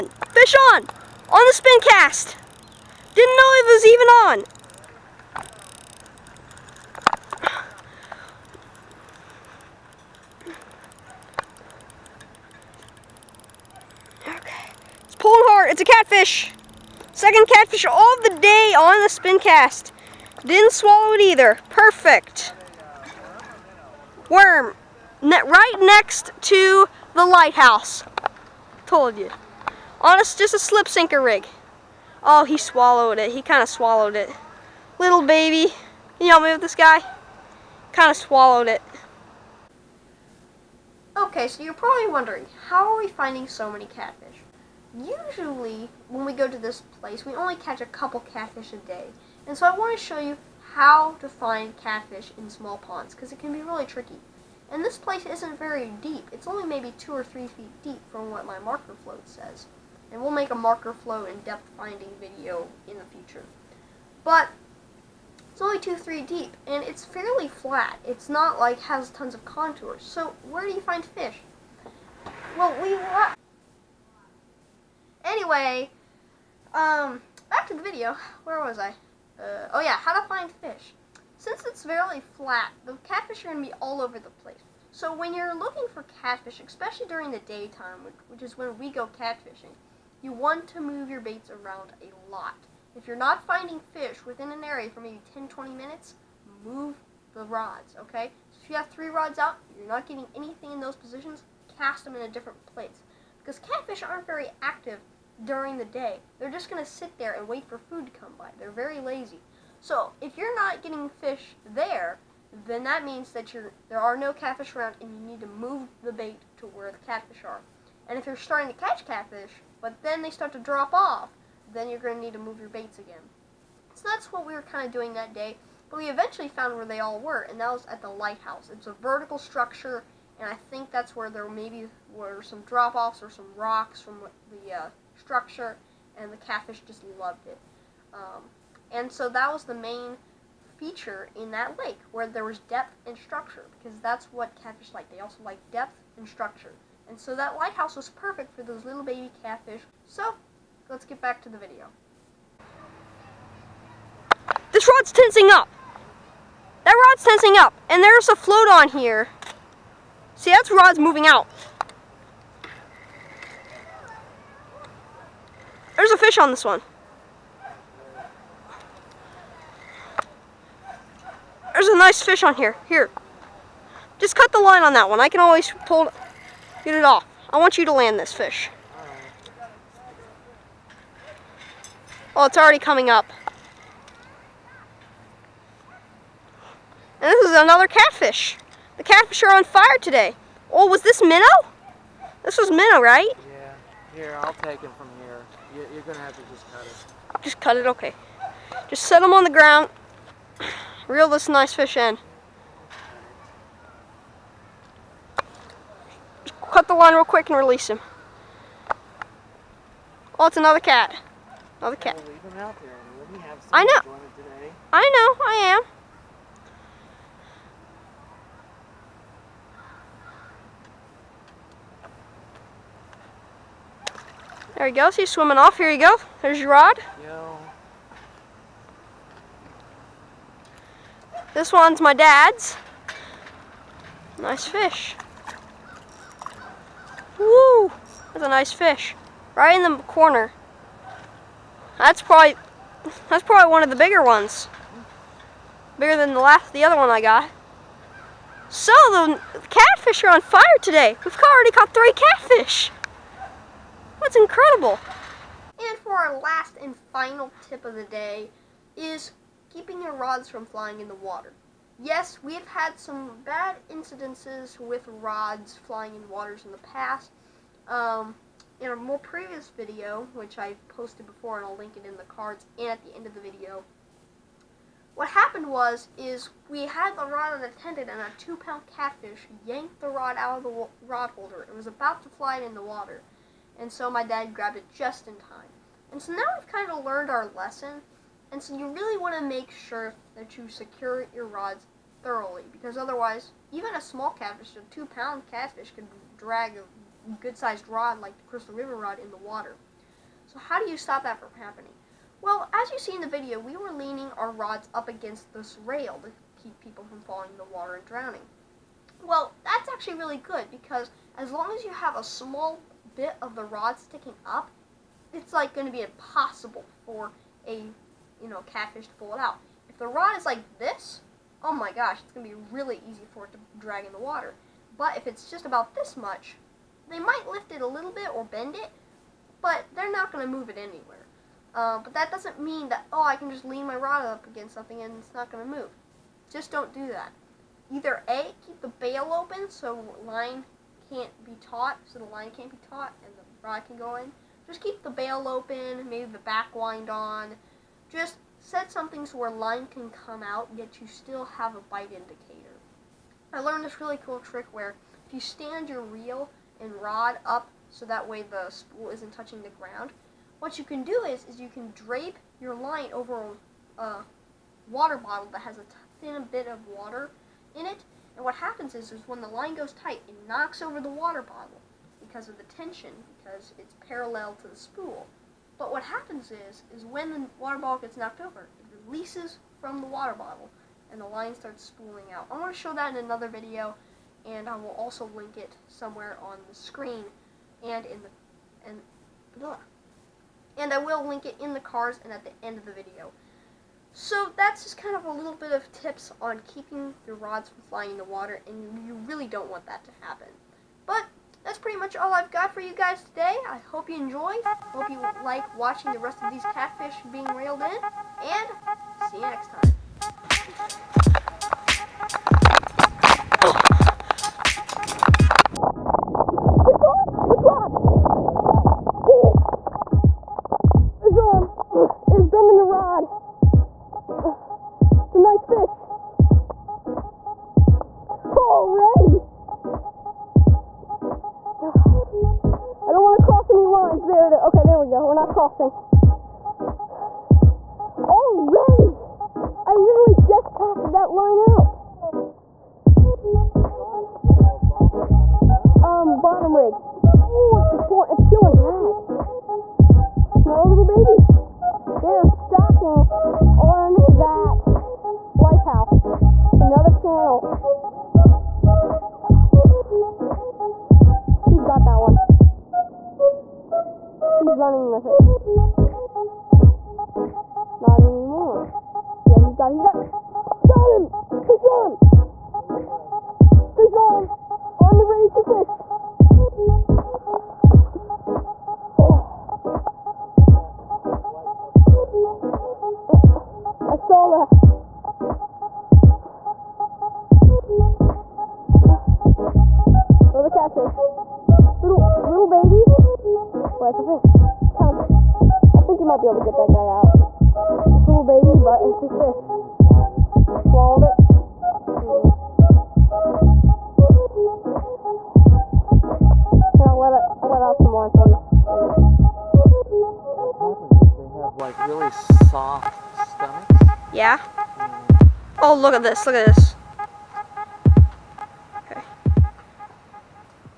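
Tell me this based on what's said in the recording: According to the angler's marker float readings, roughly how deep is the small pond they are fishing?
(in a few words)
2 or 3 feet.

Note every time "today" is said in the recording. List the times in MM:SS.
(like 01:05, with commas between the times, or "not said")
03:09, 04:10, 06:43.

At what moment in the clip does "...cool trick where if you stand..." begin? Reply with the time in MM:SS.
05:54.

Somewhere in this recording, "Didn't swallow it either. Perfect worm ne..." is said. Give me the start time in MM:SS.
00:20.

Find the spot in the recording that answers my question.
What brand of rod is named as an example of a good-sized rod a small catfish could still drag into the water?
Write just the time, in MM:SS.
04:58.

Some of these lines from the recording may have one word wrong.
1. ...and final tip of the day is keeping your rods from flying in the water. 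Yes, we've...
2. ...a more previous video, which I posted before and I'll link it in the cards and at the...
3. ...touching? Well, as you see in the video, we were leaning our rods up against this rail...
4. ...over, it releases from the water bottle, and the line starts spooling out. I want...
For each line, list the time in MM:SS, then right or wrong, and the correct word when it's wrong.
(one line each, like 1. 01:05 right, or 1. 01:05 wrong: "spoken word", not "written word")
1. 04:16 right
2. 04:28 right
3. 05:01 wrong: "happening", not "touching"
4. 06:18 right.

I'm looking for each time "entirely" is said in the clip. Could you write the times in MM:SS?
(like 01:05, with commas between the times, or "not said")
not said.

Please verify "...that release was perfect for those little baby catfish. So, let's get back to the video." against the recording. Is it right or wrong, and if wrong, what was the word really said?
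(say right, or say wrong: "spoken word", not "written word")
wrong: "lighthouse", not "release".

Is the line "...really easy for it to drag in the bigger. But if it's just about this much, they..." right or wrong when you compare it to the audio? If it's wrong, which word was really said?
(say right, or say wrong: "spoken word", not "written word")
wrong: "water", not "bigger".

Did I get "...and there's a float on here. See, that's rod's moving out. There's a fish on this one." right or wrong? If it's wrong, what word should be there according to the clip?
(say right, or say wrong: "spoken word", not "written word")
right.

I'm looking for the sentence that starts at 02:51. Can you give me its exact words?
There's a nice fish on here.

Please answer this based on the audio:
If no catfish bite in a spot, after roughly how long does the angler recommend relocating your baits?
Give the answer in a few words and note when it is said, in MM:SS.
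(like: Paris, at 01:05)
10 to 20 minutes, at 01:35.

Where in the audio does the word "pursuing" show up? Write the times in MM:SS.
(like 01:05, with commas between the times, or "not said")
not said.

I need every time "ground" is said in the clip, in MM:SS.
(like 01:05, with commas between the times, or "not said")
03:19, 05:59.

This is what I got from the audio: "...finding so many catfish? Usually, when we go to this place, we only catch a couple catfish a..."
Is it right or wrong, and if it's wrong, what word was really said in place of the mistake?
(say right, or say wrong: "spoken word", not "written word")
right.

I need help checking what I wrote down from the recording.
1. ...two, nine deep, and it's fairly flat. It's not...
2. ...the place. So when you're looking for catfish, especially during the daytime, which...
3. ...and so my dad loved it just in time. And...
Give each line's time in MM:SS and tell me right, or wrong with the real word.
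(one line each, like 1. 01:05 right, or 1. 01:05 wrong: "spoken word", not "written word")
1. 01:05 wrong: "three", not "nine"
2. 01:24 right
3. 04:43 wrong: "grabbed", not "loved".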